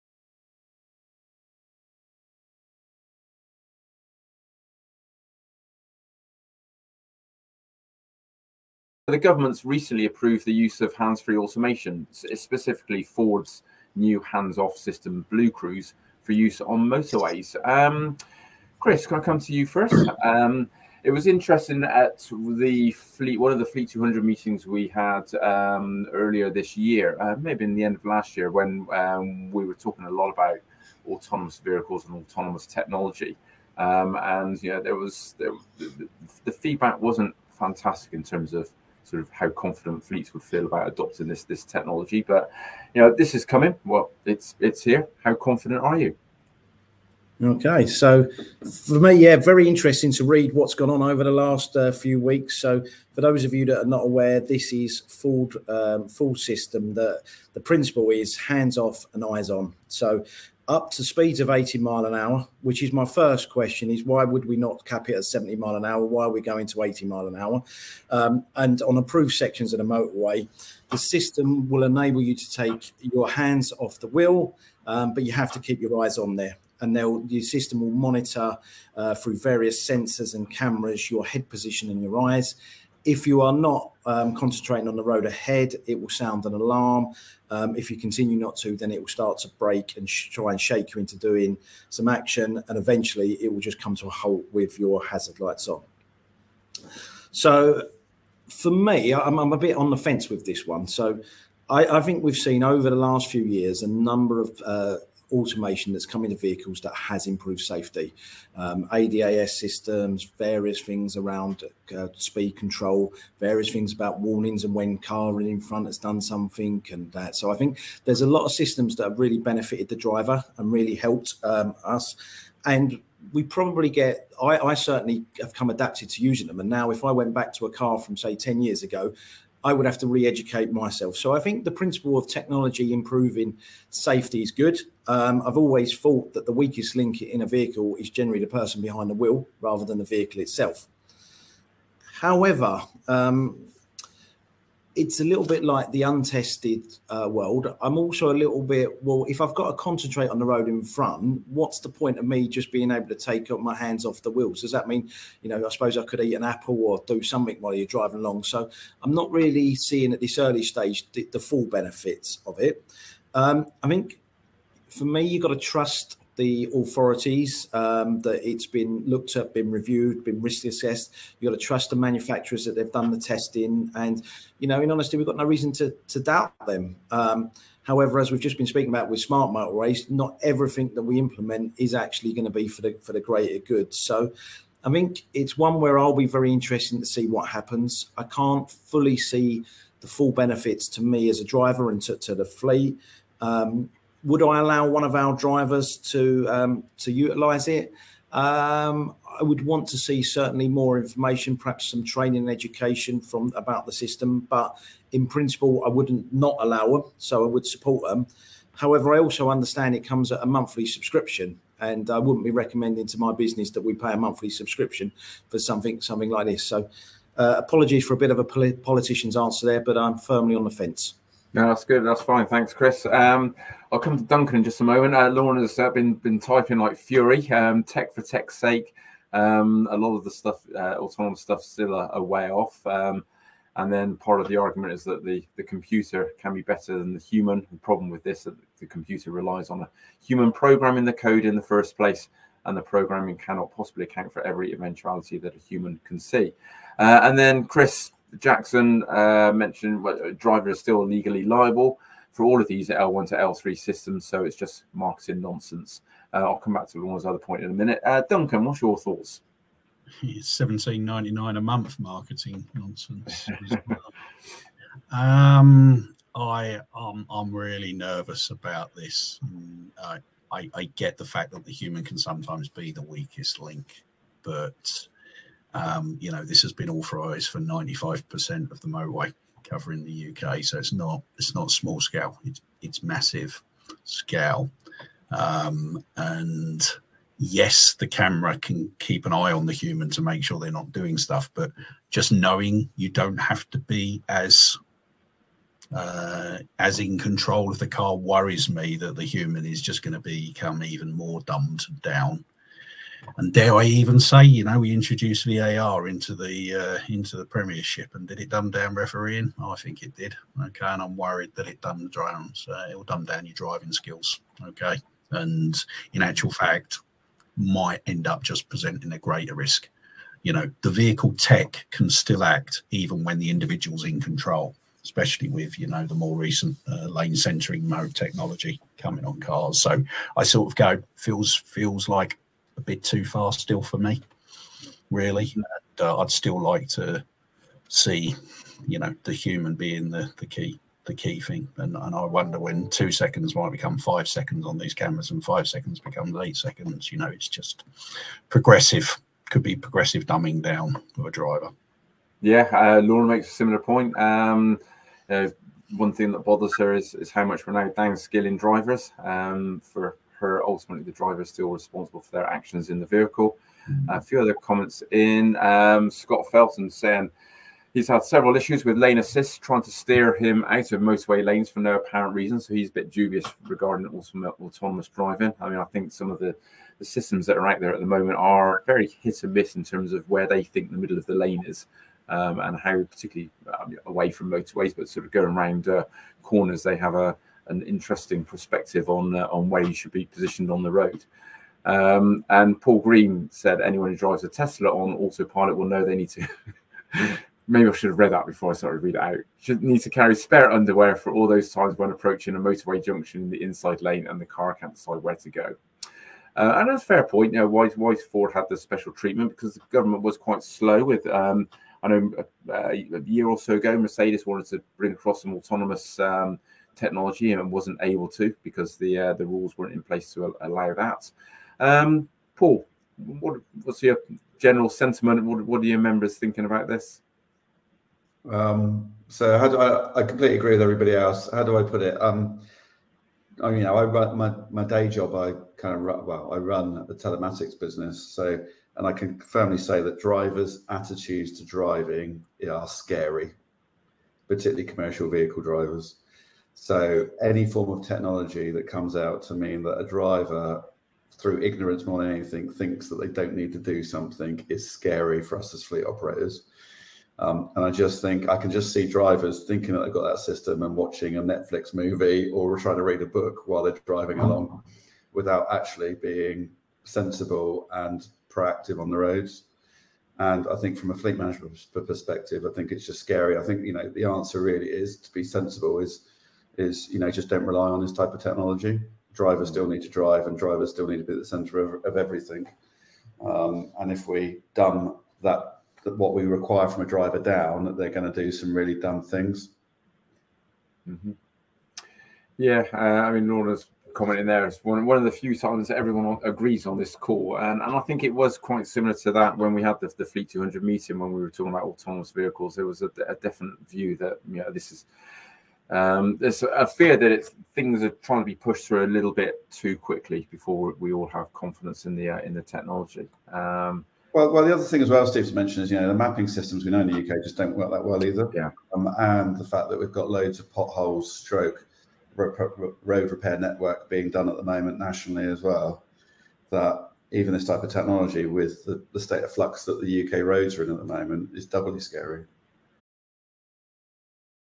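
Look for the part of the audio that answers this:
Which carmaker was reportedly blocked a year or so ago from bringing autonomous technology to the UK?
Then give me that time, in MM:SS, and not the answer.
06:53.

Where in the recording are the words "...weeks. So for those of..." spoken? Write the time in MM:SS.
00:52.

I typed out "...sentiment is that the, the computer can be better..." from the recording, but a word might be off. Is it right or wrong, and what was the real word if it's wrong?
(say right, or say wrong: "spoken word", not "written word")
wrong: "argument", not "sentiment".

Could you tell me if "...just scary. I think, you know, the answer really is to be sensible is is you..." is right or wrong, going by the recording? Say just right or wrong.
right.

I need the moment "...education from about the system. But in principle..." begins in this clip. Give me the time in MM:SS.
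03:22.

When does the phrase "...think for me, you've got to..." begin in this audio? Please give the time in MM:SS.
02:43.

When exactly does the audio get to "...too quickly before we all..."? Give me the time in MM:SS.
08:29.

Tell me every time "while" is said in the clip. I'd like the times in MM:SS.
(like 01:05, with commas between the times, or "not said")
02:37, 07:43.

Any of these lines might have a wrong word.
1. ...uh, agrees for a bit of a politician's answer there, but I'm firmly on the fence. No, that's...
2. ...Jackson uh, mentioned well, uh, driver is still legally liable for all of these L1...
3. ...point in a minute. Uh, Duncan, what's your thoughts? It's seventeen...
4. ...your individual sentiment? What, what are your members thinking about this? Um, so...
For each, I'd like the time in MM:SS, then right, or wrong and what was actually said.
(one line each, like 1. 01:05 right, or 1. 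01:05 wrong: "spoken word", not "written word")
1. 03:37 wrong: "apologies", not "agrees"
2. 04:08 right
3. 04:17 right
4. 07:04 wrong: "general", not "individual".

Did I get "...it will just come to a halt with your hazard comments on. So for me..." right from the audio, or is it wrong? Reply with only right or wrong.
wrong.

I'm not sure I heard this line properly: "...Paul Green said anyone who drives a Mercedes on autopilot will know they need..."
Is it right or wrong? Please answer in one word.
wrong.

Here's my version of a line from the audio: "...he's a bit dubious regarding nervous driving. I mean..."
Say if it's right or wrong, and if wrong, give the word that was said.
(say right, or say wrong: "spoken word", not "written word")
wrong: "autonomous", not "nervous".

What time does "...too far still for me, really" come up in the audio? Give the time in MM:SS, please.
05:33.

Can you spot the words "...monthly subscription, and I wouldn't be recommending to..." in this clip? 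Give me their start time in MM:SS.
03:30.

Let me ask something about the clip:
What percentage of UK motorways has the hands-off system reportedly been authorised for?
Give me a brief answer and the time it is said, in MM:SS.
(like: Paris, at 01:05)
95%, at 04:37.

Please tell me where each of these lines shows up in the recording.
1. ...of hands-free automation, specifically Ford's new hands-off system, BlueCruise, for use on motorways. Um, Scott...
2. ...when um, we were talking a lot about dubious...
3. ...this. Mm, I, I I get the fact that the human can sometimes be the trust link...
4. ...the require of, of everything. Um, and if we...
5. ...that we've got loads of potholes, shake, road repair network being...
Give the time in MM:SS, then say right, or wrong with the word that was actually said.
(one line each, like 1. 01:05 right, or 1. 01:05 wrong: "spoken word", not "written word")
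1. 00:10 wrong: "Chris", not "Scott"
2. 00:28 wrong: "autonomous", not "dubious"
3. 04:28 wrong: "weakest", not "trust"
4. 08:01 wrong: "centre", not "require"
5. 08:39 wrong: "stroke", not "shake".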